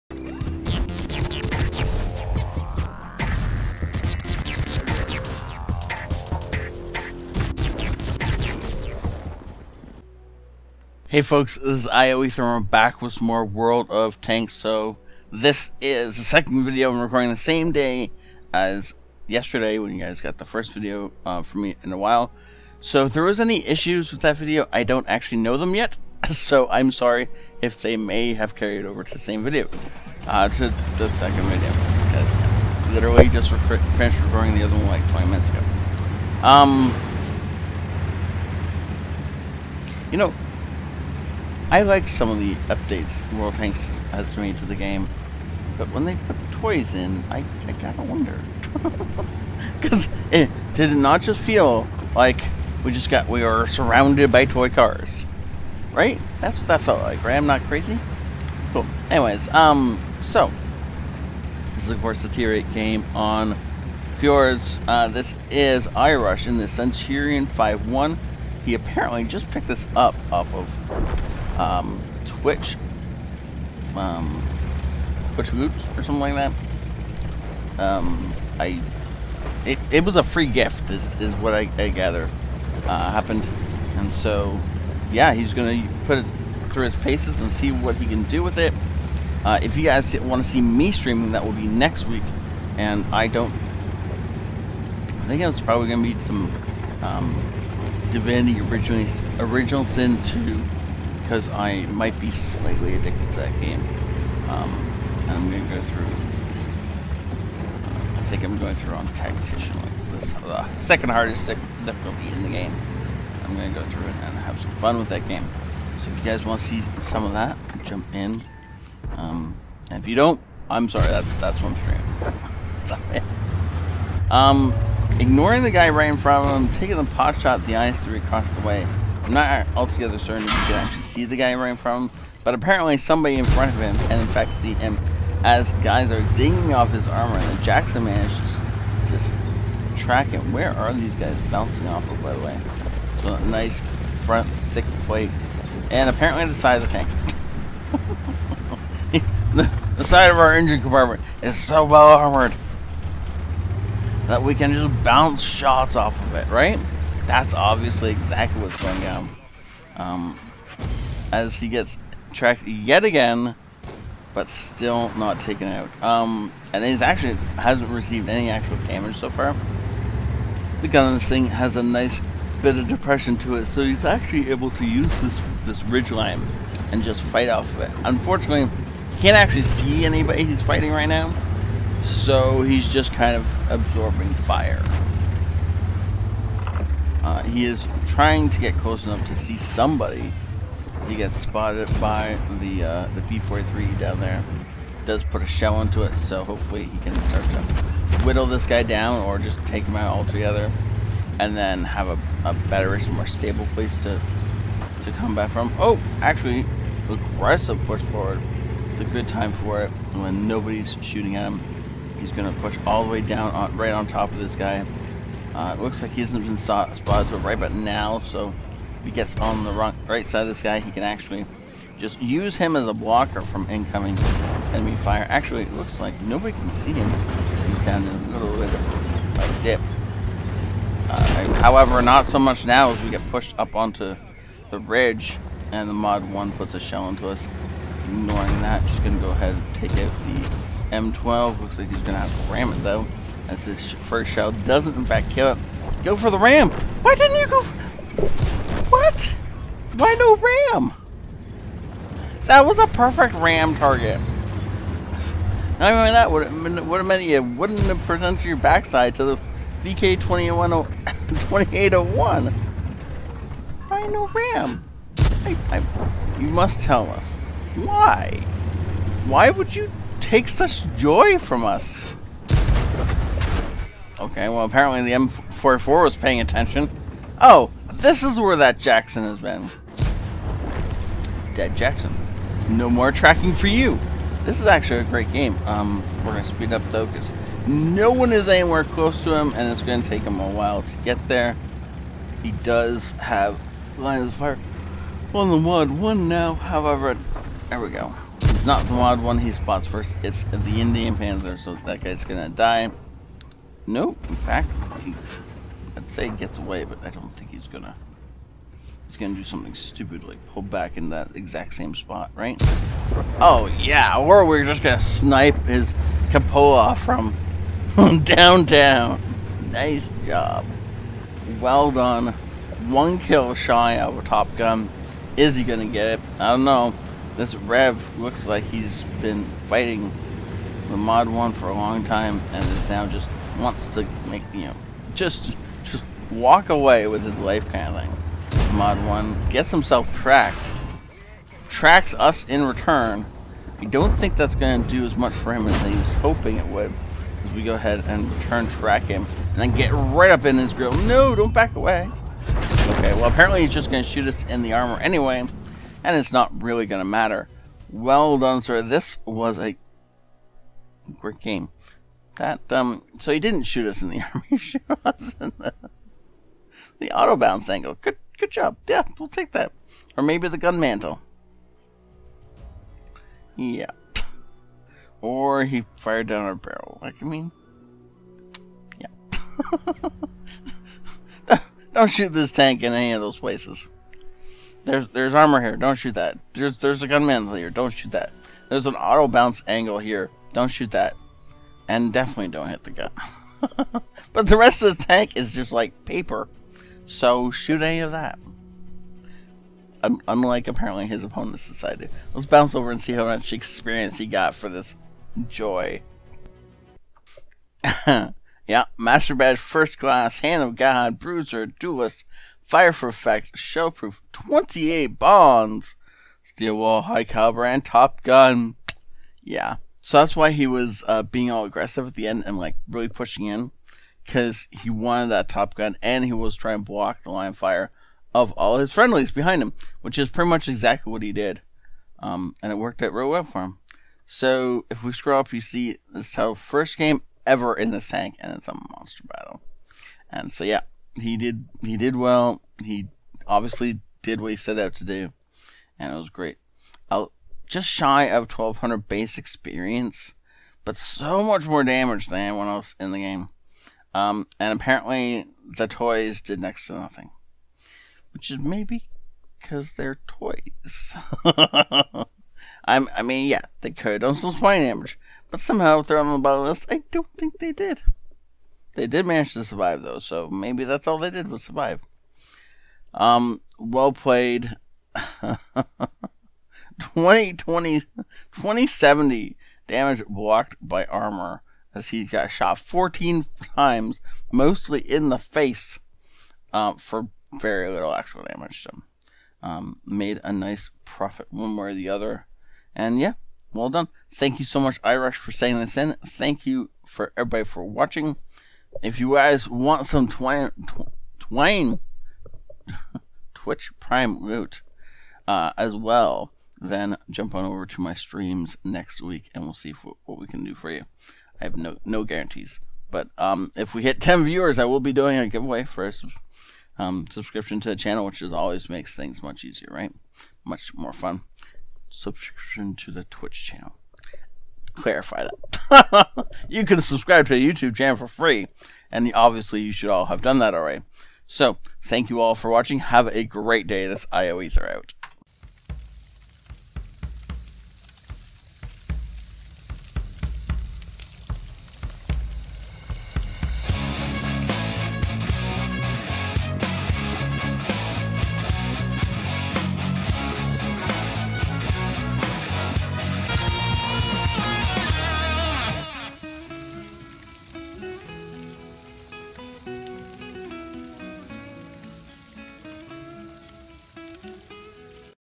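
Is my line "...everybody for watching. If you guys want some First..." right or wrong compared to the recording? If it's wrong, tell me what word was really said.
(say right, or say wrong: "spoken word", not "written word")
wrong: "Twain", not "First".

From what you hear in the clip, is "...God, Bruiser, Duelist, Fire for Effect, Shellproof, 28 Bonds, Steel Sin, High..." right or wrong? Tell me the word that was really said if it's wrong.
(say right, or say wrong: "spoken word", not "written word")
wrong: "Wall", not "Sin".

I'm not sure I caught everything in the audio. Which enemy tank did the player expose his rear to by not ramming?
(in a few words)
VK 2801.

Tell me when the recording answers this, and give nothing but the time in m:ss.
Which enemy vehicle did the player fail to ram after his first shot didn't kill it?
4:00.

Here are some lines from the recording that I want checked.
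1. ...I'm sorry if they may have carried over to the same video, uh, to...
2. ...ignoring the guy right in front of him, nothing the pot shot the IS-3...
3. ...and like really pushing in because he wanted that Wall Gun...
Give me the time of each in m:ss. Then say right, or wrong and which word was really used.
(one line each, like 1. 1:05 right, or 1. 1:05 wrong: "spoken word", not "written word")
1. 0:26 right
2. 2:05 wrong: "taking", not "nothing"
3. 7:02 wrong: "Top", not "Wall".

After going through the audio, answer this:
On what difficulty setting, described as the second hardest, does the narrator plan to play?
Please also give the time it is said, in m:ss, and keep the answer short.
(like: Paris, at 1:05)
tactician, at 1:49.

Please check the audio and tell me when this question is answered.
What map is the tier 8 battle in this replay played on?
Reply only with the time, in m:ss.
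1:04.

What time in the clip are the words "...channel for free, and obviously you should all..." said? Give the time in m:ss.
8:47.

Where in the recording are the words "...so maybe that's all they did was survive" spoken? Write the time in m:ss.
7:50.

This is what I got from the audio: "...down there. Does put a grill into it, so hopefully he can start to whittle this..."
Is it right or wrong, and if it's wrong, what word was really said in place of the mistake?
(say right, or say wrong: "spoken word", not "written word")
wrong: "shell", not "grill".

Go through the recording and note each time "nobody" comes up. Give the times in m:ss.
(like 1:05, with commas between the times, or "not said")
3:30, 3:46.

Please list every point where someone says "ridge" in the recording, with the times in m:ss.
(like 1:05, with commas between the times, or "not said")
2:55, 3:54.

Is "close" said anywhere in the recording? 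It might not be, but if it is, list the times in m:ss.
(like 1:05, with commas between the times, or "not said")
3:08, 4:48.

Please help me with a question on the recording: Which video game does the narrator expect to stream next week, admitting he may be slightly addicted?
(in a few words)
Divinity Original Sin 2.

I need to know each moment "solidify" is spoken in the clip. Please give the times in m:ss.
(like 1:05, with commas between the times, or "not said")
not said.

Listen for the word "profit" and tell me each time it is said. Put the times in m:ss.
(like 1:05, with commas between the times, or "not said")
8:11.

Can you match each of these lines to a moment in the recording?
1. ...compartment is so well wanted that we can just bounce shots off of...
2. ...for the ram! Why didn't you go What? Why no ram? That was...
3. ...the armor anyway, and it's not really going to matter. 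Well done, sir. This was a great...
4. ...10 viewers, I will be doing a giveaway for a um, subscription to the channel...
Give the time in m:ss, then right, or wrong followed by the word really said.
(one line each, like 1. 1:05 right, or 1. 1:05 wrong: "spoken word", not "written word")
1. 2:30 wrong: "armored", not "wanted"
2. 4:06 right
3. 5:54 right
4. 8:34 right.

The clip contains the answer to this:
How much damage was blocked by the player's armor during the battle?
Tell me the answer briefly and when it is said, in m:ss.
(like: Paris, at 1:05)
2070, at 7:57.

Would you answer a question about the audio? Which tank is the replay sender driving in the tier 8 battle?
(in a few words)
Centurion 5-1.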